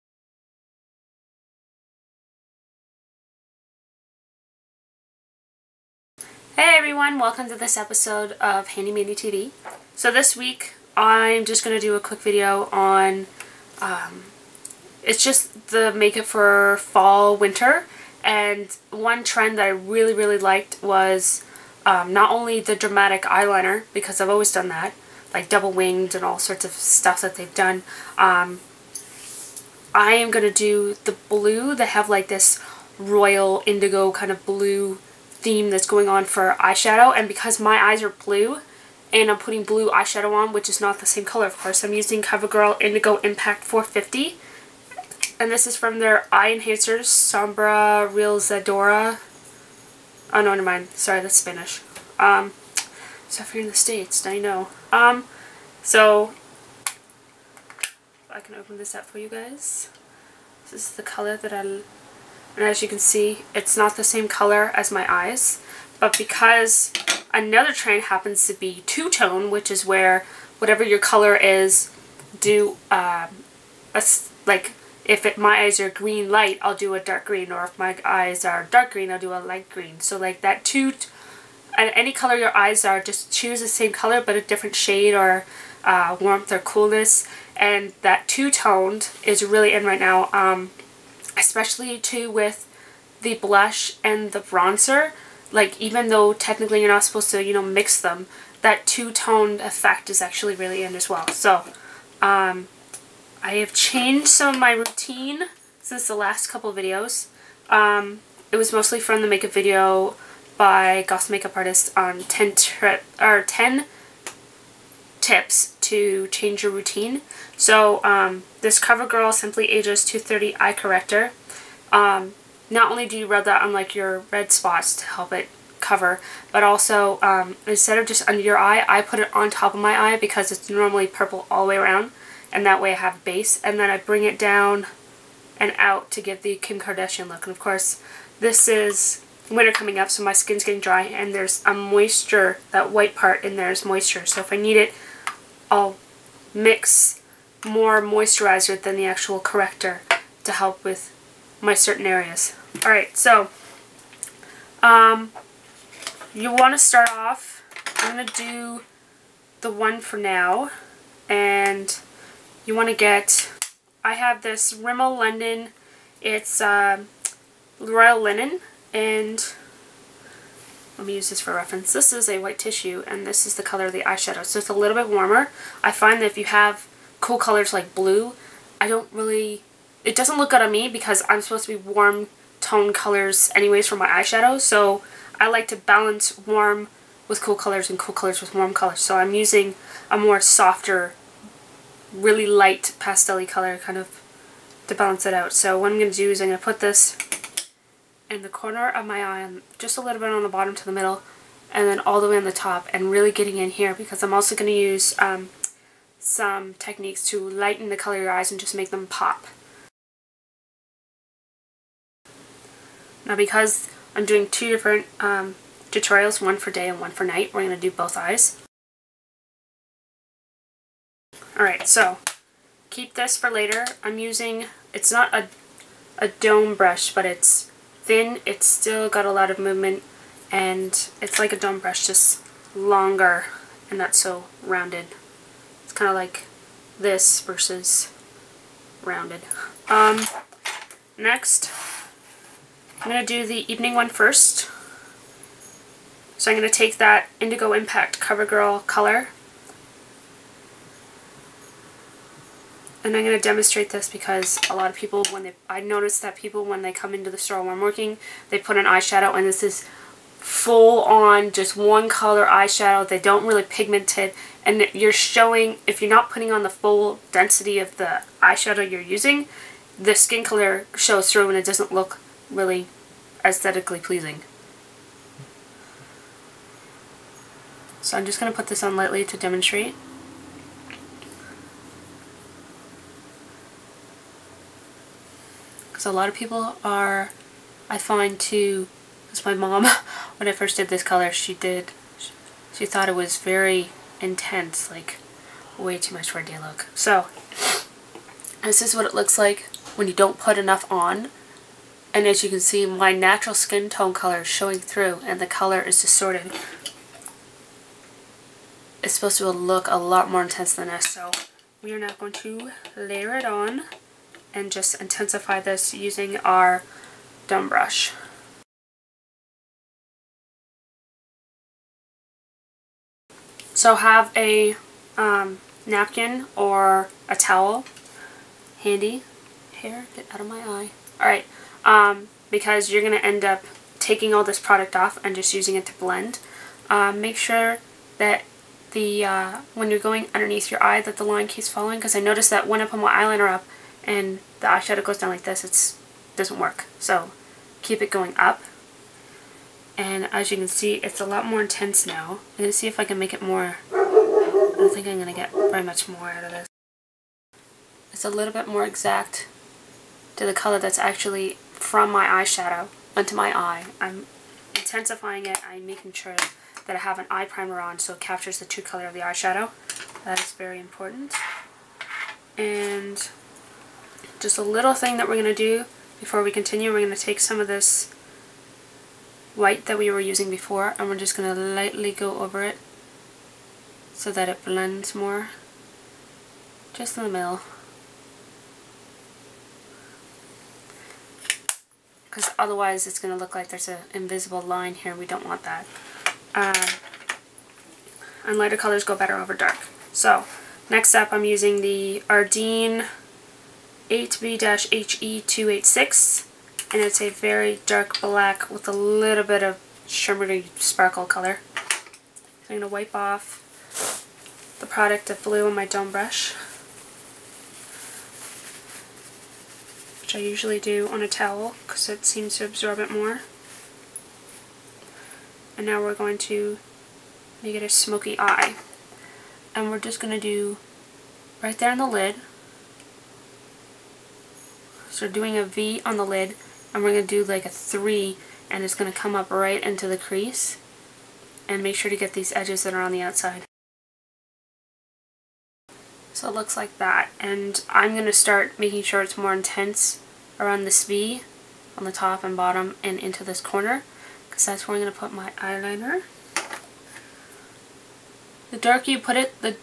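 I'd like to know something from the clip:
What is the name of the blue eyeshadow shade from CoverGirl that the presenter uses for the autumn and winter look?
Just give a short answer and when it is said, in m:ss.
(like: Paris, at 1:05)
Indigo Impact 450, at 0:42.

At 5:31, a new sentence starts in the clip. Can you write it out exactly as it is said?
Alright, um, because you're going to end up taking all this product off and just using it to blend.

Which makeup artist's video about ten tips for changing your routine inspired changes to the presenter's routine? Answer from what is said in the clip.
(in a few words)
Goss.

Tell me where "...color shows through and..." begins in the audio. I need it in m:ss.
4:30.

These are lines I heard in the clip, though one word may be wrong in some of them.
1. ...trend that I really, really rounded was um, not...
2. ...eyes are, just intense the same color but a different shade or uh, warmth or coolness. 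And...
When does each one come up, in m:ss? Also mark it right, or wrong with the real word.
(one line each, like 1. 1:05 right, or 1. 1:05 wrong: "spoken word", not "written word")
1. 0:19 wrong: "liked", not "rounded"
2. 1:22 wrong: "choose", not "intense".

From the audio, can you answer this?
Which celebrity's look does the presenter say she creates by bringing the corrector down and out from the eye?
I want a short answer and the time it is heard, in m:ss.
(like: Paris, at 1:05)
Kim Kardashian, at 2:16.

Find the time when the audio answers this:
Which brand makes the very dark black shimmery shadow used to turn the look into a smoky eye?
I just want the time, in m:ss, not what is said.
6:42.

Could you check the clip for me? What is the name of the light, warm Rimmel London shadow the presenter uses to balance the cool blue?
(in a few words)
Royal Linen.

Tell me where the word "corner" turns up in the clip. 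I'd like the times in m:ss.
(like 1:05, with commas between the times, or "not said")
3:18, 7:33.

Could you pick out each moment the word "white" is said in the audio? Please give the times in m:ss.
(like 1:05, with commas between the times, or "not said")
2:22, 2:52, 6:19.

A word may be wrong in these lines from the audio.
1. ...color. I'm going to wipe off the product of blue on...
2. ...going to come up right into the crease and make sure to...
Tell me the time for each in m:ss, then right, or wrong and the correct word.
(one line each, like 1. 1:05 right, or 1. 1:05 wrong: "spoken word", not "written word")
1. 6:51 right
2. 7:18 right.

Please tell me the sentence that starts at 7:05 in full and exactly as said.
And now we're going to make it a smoky eye.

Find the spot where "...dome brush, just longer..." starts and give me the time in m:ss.
3:51.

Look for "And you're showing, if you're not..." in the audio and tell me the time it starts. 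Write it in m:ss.
4:24.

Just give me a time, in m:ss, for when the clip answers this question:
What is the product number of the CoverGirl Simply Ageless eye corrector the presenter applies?
2:00.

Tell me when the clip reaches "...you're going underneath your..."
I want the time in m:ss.
5:39.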